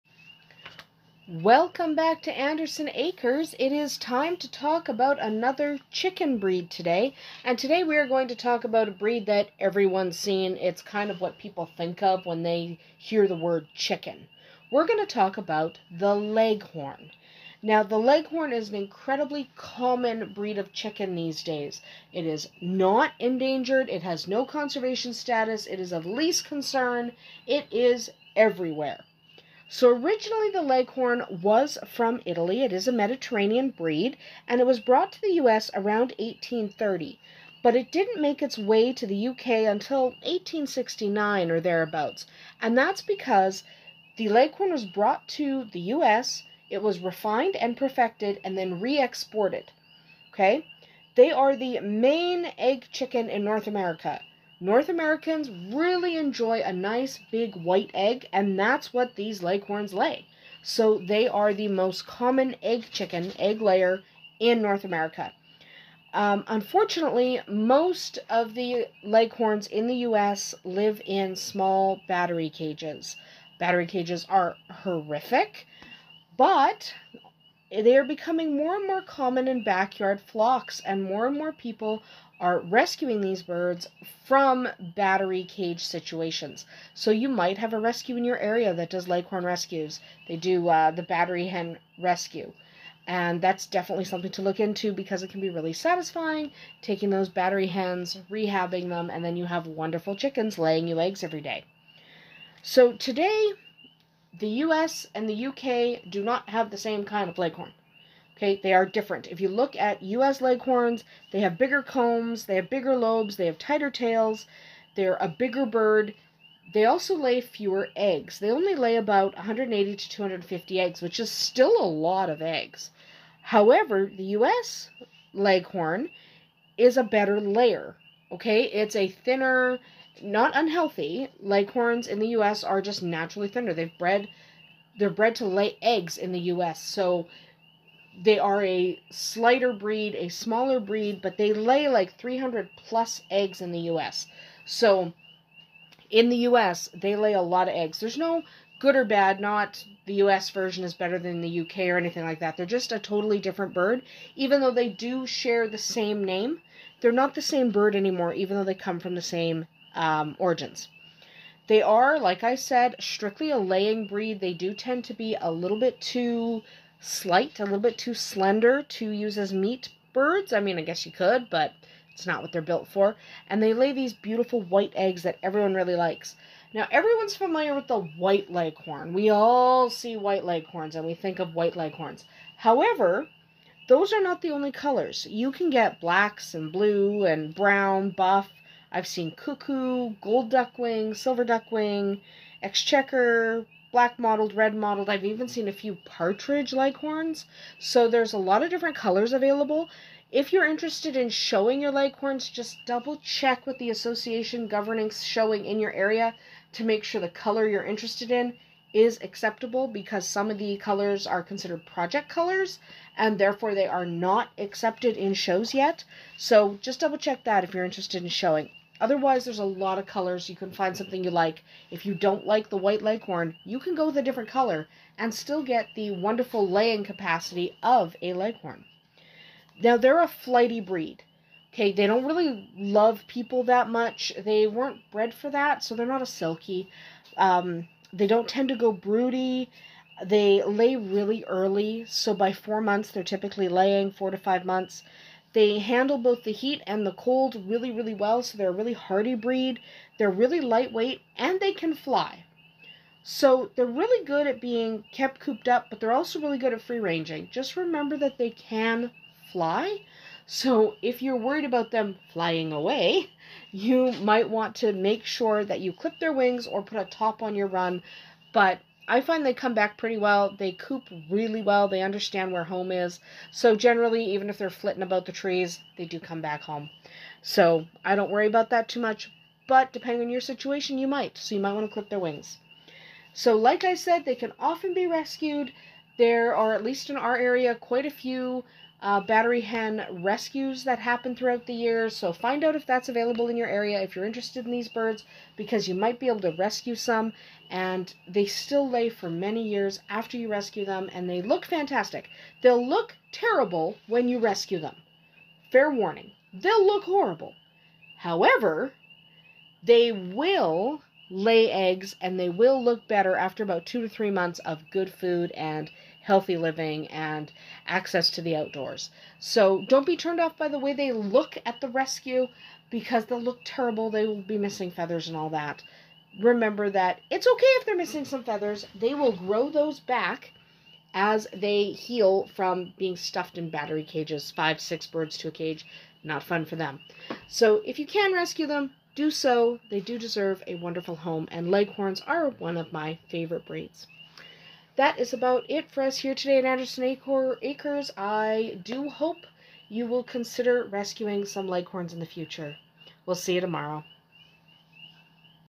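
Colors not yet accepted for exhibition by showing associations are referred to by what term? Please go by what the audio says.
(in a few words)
project colors.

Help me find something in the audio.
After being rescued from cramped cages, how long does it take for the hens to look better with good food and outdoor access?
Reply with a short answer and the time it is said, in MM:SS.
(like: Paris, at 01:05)
2 to 3 months, at 05:13.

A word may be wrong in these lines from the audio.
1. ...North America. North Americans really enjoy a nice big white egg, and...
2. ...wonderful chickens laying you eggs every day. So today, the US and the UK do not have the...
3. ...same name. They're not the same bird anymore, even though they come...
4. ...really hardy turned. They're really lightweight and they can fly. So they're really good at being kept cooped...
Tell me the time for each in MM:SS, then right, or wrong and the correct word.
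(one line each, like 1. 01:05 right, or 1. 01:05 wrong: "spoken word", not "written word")
1. 00:53 right
2. 01:39 right
3. 02:35 right
4. 04:08 wrong: "breed", not "turned".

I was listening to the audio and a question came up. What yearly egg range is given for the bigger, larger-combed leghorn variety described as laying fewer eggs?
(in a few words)
180 to 250.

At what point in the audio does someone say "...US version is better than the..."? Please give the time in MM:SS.
02:30.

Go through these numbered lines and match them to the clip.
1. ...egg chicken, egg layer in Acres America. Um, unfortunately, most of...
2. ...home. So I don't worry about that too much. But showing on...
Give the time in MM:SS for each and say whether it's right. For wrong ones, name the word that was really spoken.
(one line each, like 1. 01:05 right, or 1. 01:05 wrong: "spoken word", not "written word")
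1. 01:02 wrong: "North", not "Acres"
2. 04:36 wrong: "depending", not "showing".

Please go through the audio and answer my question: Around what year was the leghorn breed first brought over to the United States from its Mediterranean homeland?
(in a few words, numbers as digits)
1830.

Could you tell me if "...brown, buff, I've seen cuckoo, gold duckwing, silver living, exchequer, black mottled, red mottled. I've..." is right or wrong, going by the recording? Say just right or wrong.
wrong.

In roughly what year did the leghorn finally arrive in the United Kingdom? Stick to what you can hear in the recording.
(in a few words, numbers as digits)
1869.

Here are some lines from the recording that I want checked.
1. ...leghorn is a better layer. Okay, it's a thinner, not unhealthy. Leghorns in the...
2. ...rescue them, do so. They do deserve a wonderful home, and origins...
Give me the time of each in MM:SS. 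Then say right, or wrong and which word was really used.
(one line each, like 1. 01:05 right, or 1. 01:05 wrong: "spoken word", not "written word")
1. 02:05 right
2. 05:38 wrong: "leghorns", not "origins".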